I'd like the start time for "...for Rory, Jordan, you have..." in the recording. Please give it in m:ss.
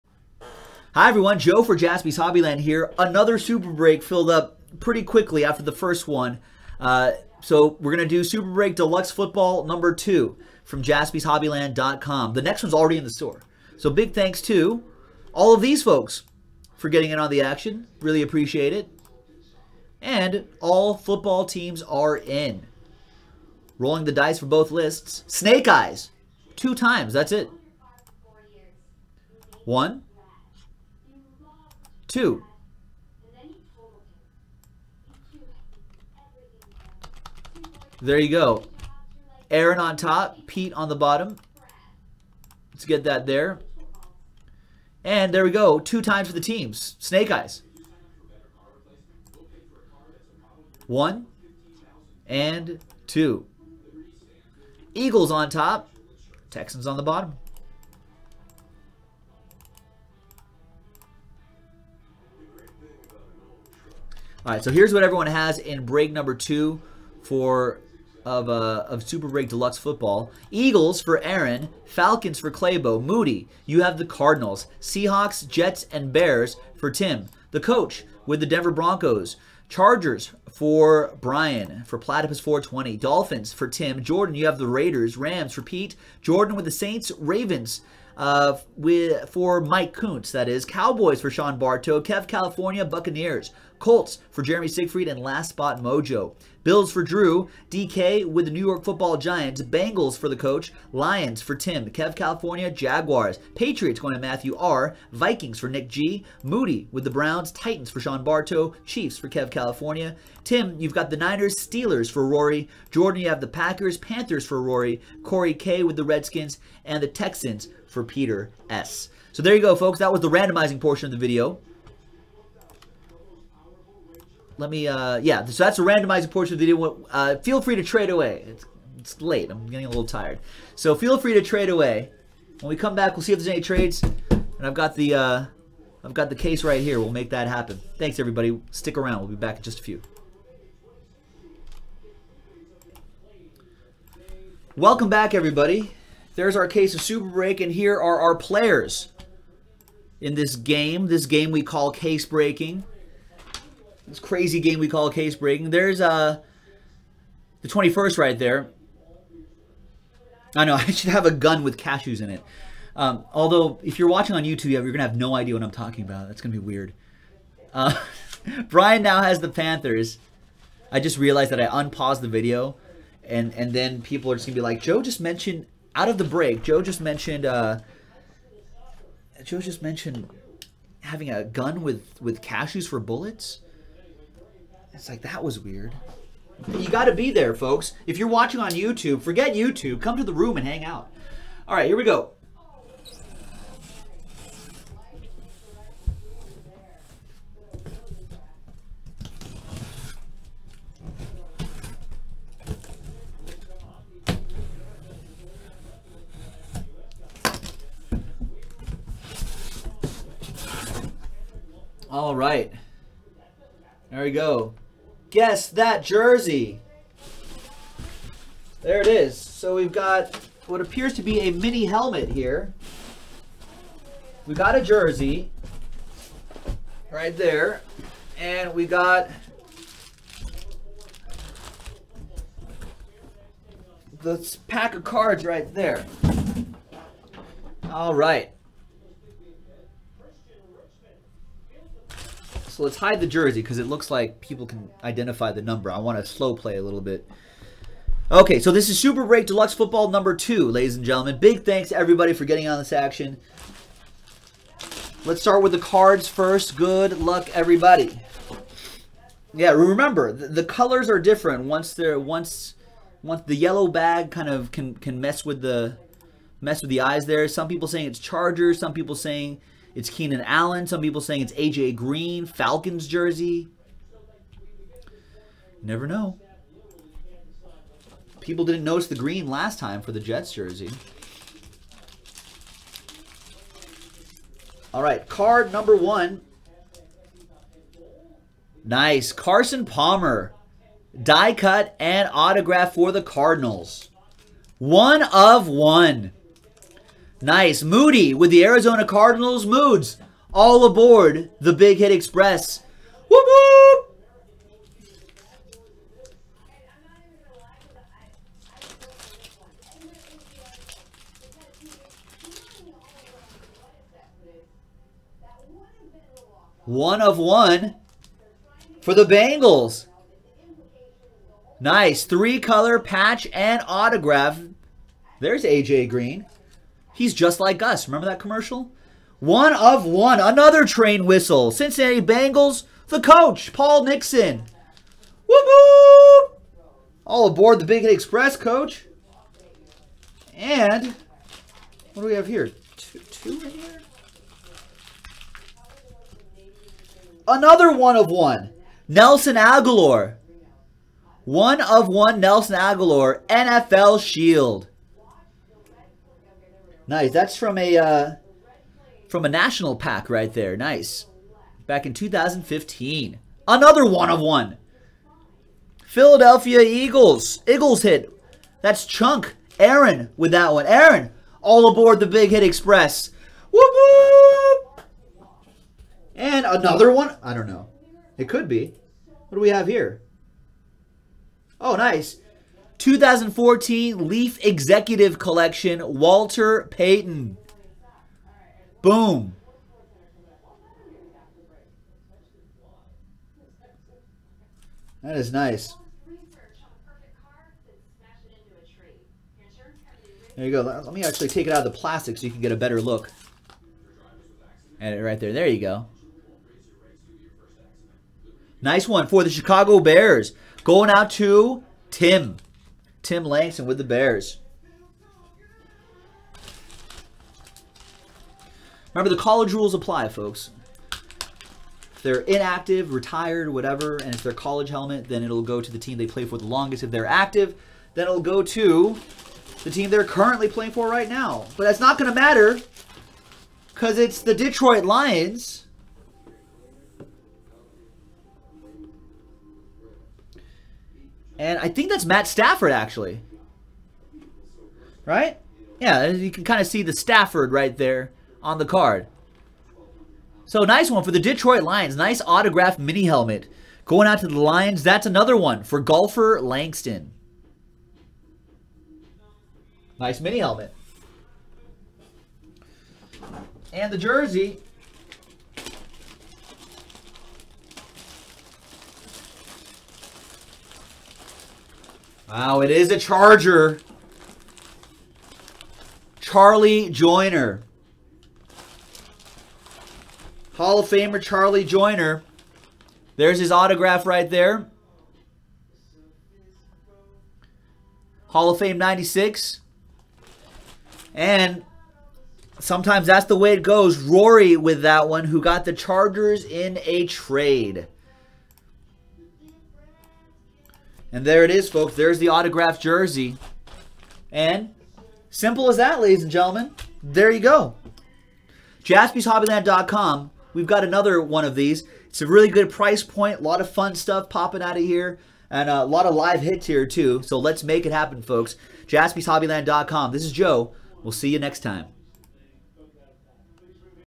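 1:52.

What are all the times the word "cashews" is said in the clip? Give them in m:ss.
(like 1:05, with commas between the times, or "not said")
2:41, 3:02.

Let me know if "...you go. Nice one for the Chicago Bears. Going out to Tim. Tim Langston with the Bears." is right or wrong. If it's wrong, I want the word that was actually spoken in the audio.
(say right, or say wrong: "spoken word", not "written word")
right.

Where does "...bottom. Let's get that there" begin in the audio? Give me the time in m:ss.
0:40.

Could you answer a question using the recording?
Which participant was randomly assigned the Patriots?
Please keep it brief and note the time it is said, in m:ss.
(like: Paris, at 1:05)
Matthew R, at 1:43.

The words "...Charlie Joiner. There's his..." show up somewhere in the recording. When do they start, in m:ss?
8:01.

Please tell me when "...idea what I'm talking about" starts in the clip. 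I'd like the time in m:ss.
2:45.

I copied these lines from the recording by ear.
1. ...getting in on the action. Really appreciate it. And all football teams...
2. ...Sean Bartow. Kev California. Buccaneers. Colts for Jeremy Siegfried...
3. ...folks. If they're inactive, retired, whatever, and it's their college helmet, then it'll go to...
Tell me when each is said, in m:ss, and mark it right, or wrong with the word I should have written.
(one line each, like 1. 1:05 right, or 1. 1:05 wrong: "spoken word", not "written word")
1. 0:16 right
2. 1:31 right
3. 7:00 right.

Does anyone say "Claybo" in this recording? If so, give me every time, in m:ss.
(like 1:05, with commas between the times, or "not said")
1:12.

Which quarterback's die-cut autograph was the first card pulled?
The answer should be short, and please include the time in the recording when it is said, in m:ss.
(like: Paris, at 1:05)
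Carson Palmer, at 4:49.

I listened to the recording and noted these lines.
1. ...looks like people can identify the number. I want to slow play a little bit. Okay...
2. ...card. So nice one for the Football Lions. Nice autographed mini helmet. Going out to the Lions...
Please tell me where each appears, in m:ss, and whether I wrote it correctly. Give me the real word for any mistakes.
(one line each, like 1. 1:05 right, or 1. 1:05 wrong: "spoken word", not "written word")
1. 4:03 right
2. 7:28 wrong: "Detroit", not "Football".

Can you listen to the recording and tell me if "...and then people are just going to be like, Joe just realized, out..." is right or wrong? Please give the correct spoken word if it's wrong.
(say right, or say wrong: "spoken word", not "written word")
wrong: "mentioned", not "realized".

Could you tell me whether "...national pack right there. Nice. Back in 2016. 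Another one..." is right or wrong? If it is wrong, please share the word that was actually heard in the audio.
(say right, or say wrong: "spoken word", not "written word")
wrong: "2015", not "2016".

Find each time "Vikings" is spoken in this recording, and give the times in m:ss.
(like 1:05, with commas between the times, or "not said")
1:45.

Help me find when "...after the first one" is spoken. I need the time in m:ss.
0:05.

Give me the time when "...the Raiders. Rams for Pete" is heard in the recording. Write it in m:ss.
1:24.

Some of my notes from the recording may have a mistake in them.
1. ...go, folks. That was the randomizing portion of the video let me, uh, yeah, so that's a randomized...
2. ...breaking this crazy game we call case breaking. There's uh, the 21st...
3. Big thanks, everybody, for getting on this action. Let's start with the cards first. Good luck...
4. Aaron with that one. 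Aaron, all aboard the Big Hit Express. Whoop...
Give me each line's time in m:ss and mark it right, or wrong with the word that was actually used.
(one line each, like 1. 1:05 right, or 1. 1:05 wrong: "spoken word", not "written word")
1. 1:59 right
2. 2:32 right
3. 4:11 right
4. 6:09 right.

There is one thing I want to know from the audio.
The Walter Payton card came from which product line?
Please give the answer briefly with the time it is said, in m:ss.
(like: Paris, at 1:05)
Leaf Executive Collection, at 6:24.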